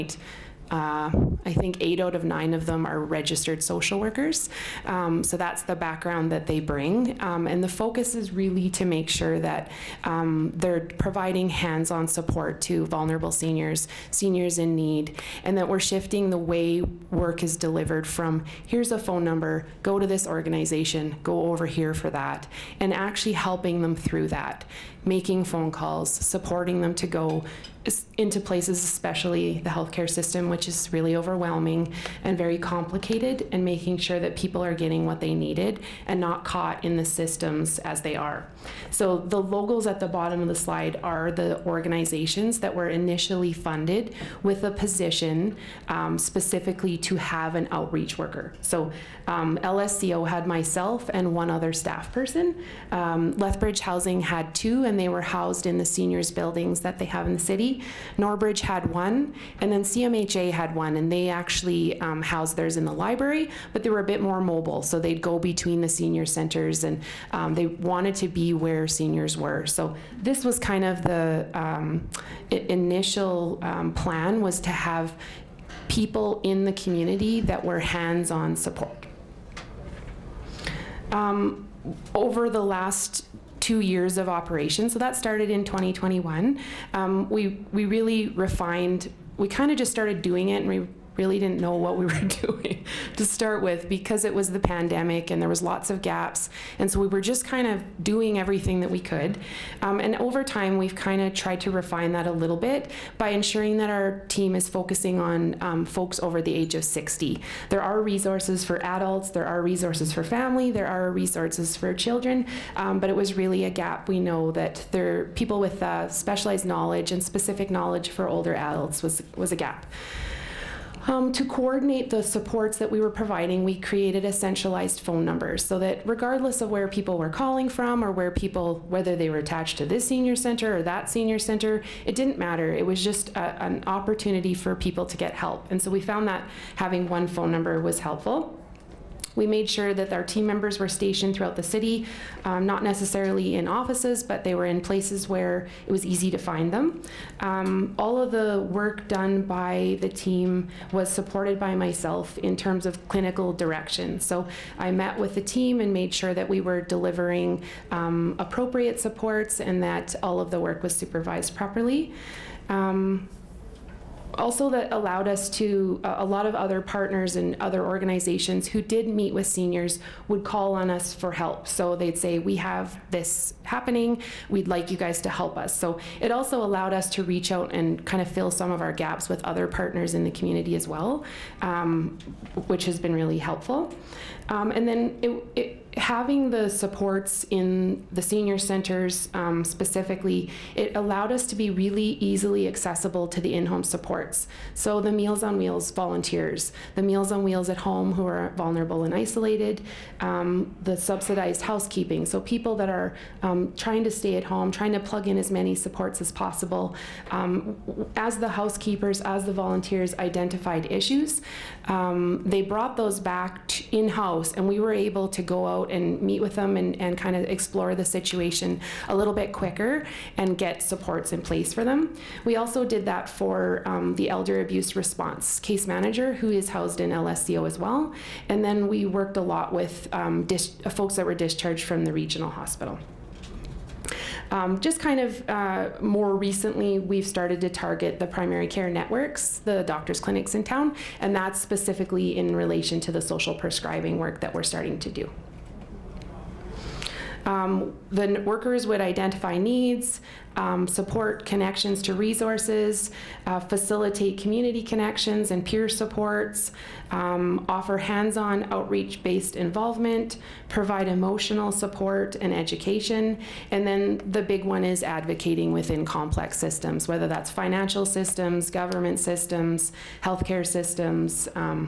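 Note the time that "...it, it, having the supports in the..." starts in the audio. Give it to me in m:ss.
3:05.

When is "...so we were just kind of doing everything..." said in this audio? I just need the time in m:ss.
1:36.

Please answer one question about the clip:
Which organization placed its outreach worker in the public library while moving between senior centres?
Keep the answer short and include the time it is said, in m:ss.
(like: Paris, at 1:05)
CMHA, at 0:59.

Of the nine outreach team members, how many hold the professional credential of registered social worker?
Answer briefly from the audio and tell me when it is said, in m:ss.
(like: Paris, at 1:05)
8, at 0:01.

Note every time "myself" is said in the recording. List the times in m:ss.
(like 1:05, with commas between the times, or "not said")
0:50, 2:31.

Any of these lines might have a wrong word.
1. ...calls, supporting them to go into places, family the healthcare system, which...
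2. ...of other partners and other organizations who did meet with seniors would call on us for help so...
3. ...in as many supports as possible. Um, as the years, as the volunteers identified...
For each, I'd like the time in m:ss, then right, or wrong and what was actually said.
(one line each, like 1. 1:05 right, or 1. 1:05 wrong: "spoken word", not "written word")
1. 0:25 wrong: "especially", not "family"
2. 2:46 right
3. 3:25 wrong: "housekeepers", not "years".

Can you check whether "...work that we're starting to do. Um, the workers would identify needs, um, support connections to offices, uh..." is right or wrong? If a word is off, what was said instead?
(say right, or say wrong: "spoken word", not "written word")
wrong: "resources", not "offices".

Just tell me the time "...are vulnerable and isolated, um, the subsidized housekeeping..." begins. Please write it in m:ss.
3:18.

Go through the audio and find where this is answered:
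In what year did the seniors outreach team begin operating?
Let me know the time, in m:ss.
1:25.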